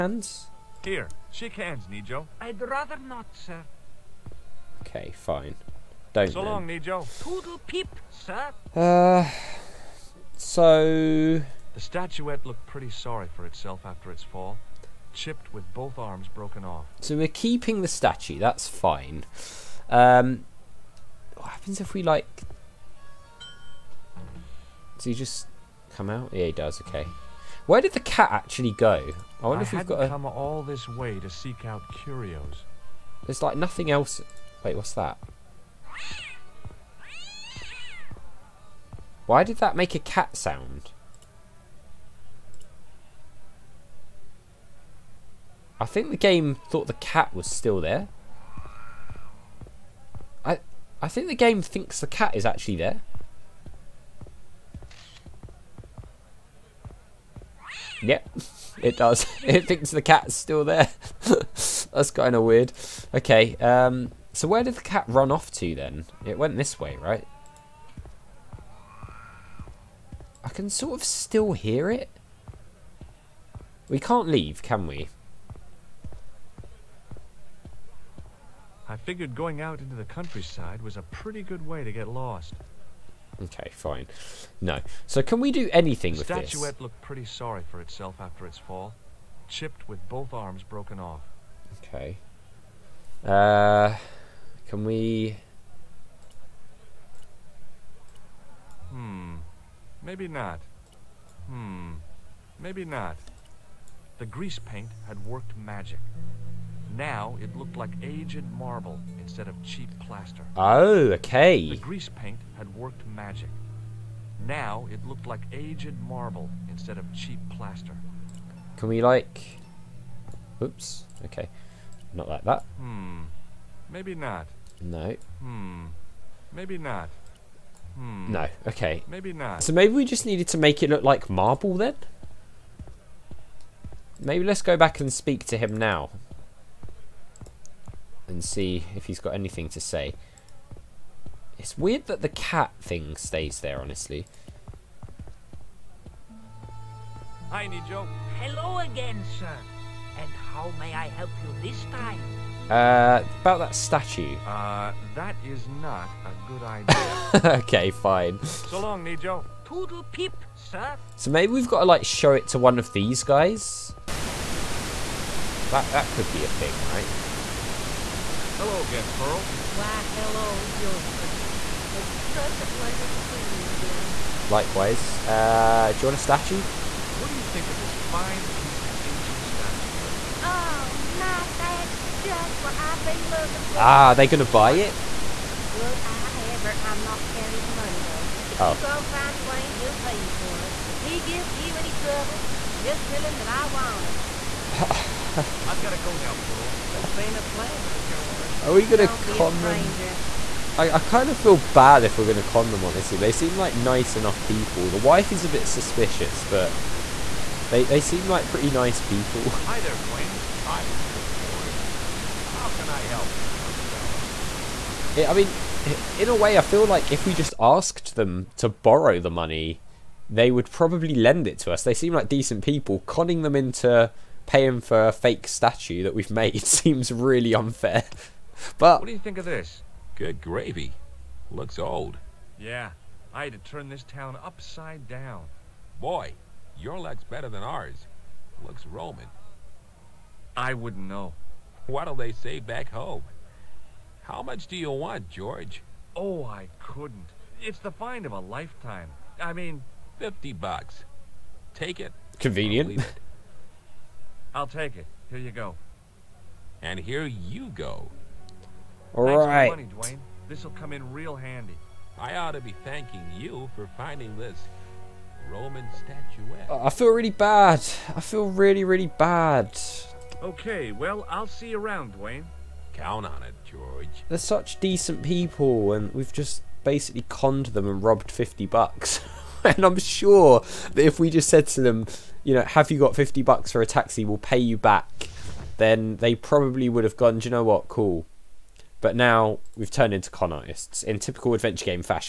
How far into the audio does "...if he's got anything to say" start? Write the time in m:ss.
2:18.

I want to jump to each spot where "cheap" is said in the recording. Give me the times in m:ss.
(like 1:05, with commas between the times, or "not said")
1:49, 1:57.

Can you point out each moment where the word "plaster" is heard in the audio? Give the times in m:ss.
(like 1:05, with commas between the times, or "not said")
1:50, 1:57.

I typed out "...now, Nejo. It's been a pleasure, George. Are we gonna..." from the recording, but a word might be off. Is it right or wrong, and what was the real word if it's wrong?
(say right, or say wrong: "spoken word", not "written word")
wrong: "Pearl", not "Nejo".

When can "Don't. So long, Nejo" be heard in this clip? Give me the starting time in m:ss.
0:06.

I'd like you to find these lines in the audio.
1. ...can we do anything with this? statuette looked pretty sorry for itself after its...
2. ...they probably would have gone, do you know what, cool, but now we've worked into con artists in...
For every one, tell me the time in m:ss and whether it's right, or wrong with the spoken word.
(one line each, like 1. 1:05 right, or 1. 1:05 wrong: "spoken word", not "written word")
1. 1:25 right
2. 4:46 wrong: "turned", not "worked".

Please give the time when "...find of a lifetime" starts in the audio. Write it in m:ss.
4:07.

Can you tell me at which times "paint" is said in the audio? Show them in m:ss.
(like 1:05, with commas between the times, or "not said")
1:44, 1:52.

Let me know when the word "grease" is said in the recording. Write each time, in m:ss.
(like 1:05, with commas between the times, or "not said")
1:44, 1:51.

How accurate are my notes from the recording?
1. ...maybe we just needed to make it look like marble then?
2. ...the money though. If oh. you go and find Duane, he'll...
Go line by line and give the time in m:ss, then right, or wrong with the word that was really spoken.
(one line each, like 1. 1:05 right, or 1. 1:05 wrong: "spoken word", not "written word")
1. 2:09 right
2. 3:07 right.